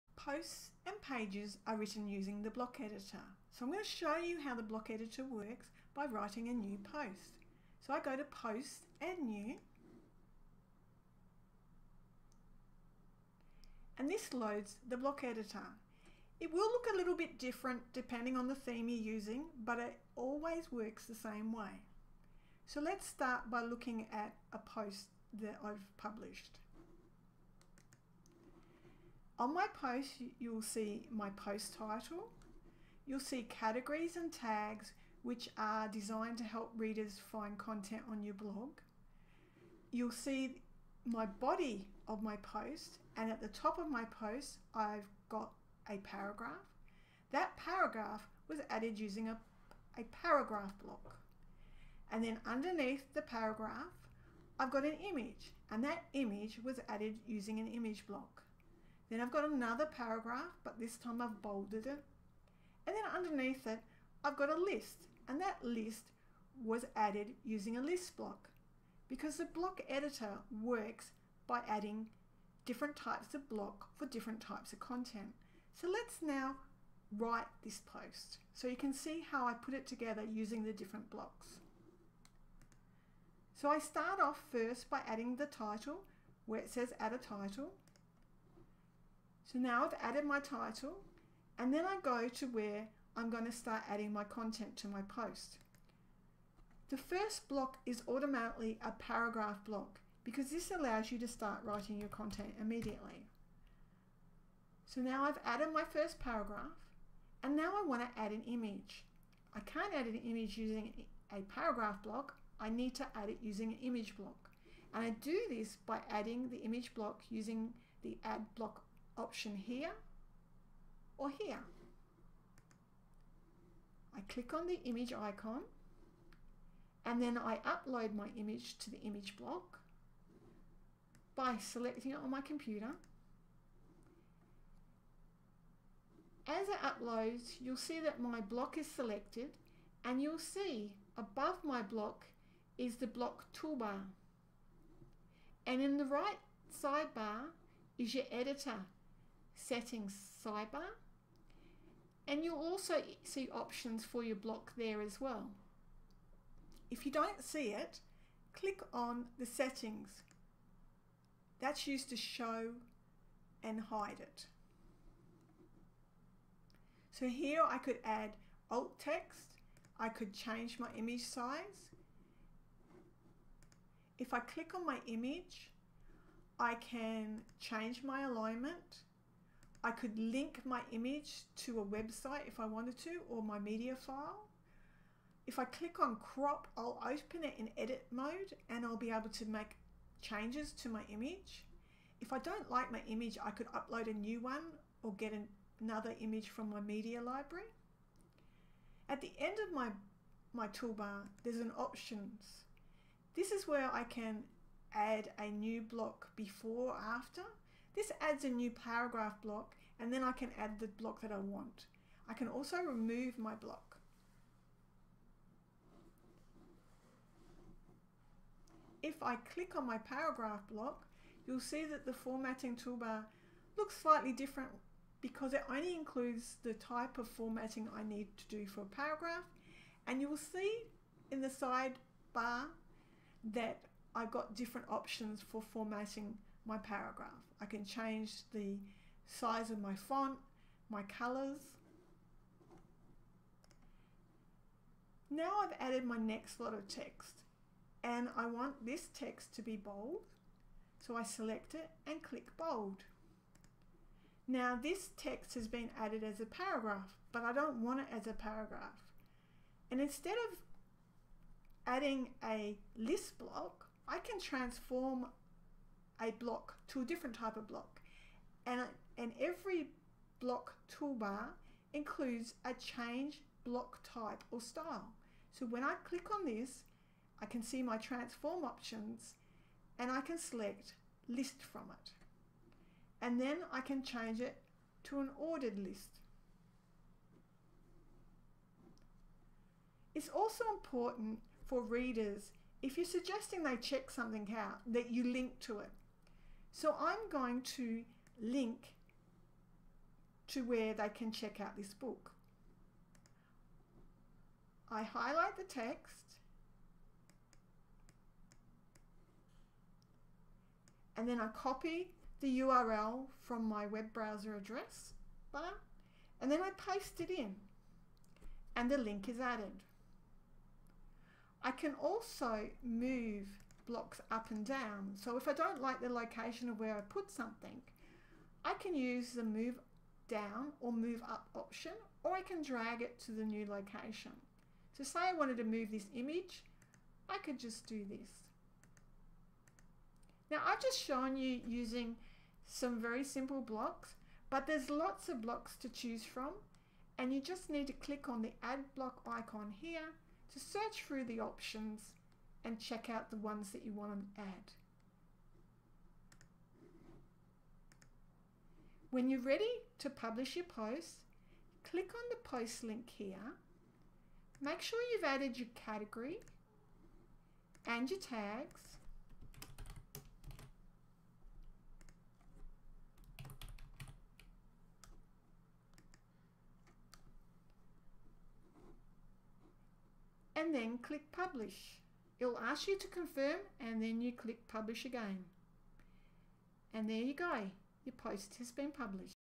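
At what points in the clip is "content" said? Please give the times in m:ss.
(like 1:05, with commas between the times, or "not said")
0:37, 1:14, 1:34, 1:42.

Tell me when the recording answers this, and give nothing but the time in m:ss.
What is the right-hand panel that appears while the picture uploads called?
2:28.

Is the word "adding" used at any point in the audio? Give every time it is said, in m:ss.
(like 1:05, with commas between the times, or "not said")
1:11, 1:25, 1:33, 1:56, 4:21.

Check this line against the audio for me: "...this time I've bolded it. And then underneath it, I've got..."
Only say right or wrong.
right.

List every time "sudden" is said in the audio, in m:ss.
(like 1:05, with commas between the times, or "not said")
not said.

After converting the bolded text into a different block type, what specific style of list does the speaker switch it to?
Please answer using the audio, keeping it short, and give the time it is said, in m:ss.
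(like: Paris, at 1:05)
Ordered list, at 4:45.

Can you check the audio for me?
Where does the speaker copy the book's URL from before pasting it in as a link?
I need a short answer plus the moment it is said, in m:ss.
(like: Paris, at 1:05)
Web browser address bar, at 5:13.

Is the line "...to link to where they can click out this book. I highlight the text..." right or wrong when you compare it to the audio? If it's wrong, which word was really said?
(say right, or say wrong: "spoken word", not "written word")
wrong: "check", not "click".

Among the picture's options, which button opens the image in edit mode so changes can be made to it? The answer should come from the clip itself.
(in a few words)
Crop.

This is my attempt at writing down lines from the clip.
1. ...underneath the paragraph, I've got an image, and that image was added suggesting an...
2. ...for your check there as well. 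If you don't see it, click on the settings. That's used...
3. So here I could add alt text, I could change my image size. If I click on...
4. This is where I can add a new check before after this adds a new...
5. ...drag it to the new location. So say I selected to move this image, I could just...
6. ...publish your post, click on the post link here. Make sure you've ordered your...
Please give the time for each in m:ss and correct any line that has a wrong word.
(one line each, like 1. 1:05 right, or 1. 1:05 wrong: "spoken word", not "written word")
1. 0:52 wrong: "using", not "suggesting"
2. 2:34 wrong: "block", not "check"
3. 2:47 right
4. 3:23 wrong: "block", not "check"
5. 5:32 wrong: "wanted", not "selected"
6. 6:00 wrong: "added", not "ordered".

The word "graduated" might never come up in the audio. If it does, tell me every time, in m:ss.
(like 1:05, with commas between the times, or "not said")
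not said.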